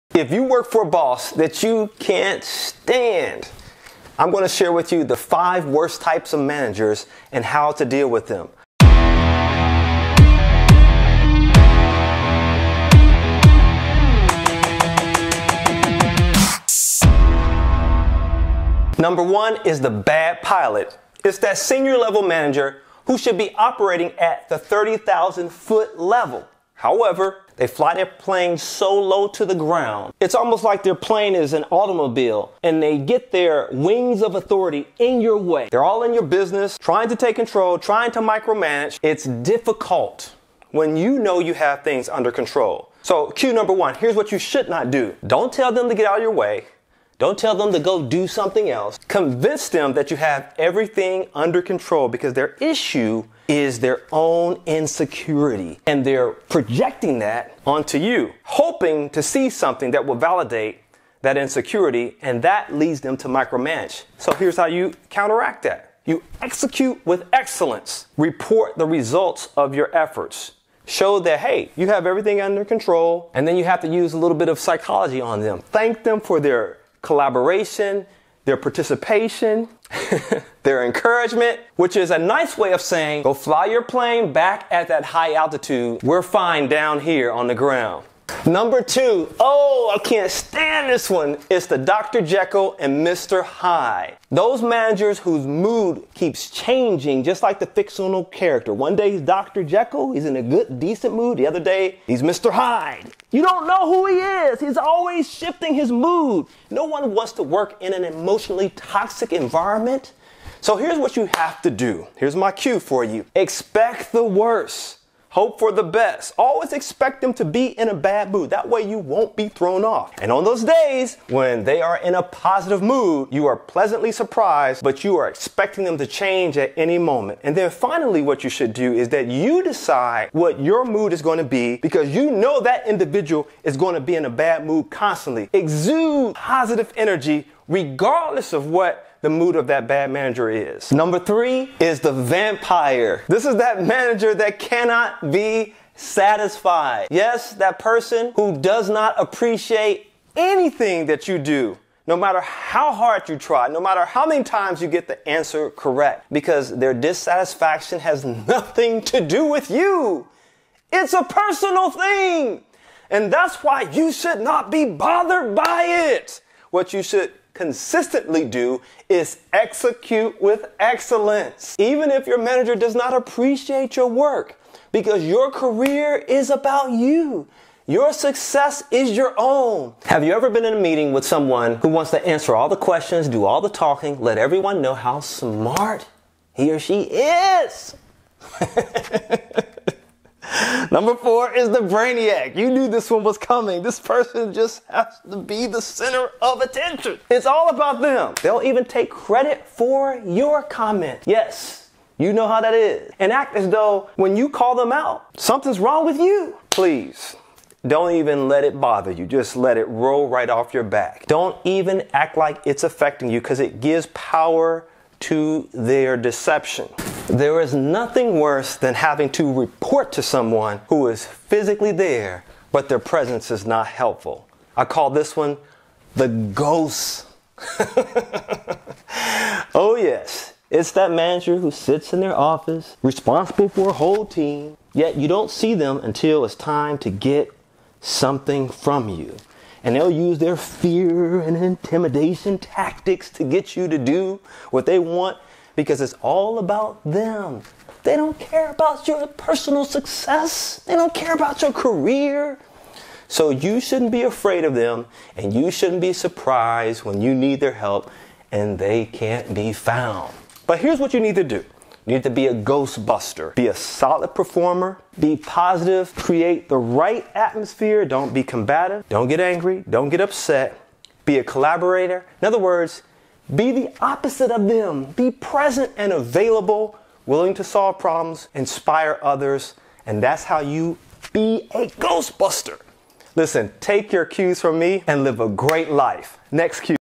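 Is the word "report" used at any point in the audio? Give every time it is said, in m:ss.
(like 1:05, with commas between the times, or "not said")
1:08, 3:39.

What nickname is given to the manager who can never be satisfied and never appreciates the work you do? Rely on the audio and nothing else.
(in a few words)
The vampire.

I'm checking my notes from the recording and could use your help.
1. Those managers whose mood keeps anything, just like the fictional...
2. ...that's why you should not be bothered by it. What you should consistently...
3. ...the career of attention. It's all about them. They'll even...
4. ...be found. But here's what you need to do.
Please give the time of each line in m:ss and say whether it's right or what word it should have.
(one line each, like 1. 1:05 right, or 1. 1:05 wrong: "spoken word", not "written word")
1. 1:34 wrong: "changing", not "anything"
2. 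2:43 right
3. 3:15 wrong: "center", not "career"
4. 4:19 right.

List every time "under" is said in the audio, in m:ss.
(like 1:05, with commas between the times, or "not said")
0:42, 0:51, 1:12.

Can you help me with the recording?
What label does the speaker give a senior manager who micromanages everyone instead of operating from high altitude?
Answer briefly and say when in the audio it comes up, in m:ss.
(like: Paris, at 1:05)
The bad pilot, at 0:19.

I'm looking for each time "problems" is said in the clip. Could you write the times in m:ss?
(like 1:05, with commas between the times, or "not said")
4:37.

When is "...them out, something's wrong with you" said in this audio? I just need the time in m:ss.
3:24.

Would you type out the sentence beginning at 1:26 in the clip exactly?
We're fine down here on the ground.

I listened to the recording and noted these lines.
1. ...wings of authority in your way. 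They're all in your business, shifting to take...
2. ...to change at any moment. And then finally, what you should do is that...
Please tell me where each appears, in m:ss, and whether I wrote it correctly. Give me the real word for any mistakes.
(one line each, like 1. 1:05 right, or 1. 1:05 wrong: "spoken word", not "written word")
1. 0:33 wrong: "trying", not "shifting"
2. 2:05 right.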